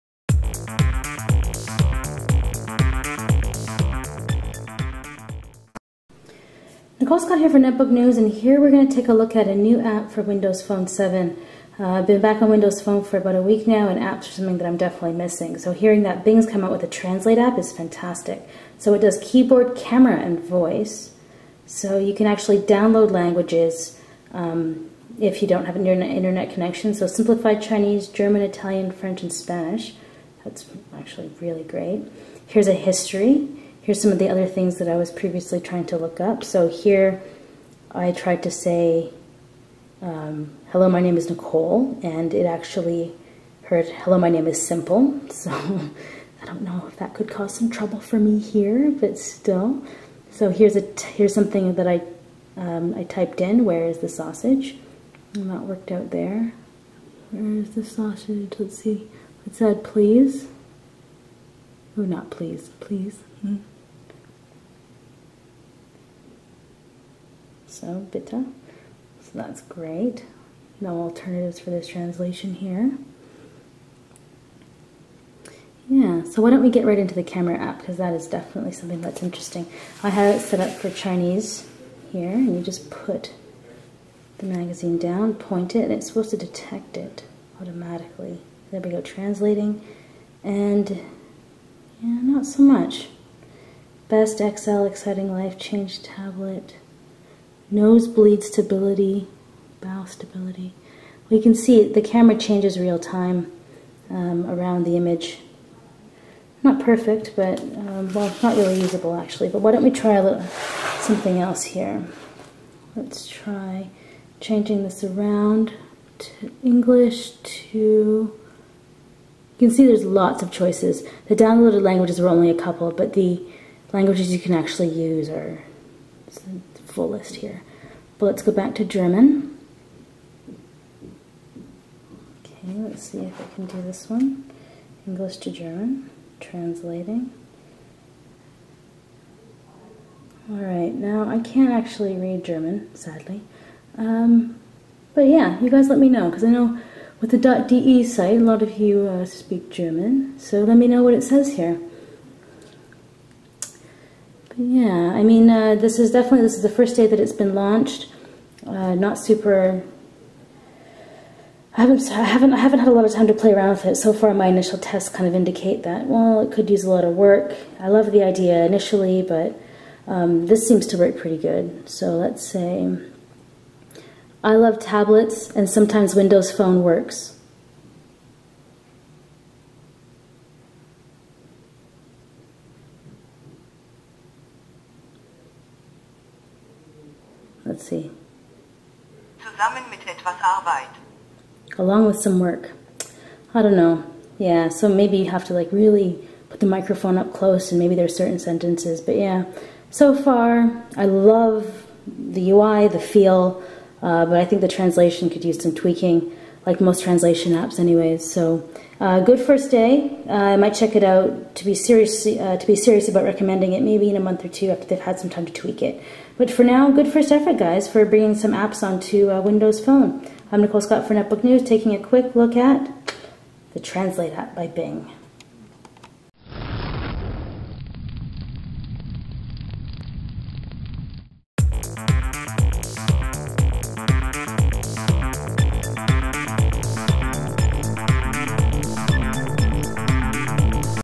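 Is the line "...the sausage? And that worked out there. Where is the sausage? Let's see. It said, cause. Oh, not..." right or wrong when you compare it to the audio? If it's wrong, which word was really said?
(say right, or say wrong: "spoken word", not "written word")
wrong: "please", not "cause".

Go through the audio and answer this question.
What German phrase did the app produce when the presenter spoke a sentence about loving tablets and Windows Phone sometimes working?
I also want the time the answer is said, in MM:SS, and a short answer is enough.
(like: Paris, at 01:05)
Zusammen mit etwas Arbeit, at 03:09.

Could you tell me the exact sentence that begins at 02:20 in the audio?
Alright, now I can't actually read German, sadly.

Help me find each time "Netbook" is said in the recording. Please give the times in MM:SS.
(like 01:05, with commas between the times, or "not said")
00:07, 03:41.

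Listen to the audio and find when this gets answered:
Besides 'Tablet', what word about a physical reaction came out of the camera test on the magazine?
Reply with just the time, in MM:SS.
01:37.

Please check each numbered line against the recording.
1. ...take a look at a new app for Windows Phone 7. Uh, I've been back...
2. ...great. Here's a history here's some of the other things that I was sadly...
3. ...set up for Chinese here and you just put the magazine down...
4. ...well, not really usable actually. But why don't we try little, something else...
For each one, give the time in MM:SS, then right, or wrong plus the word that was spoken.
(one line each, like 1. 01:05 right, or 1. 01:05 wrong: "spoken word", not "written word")
1. 00:08 right
2. 00:31 wrong: "previously", not "sadly"
3. 01:20 right
4. 01:48 right.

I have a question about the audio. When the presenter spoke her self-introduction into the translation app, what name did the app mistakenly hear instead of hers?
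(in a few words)
Simple.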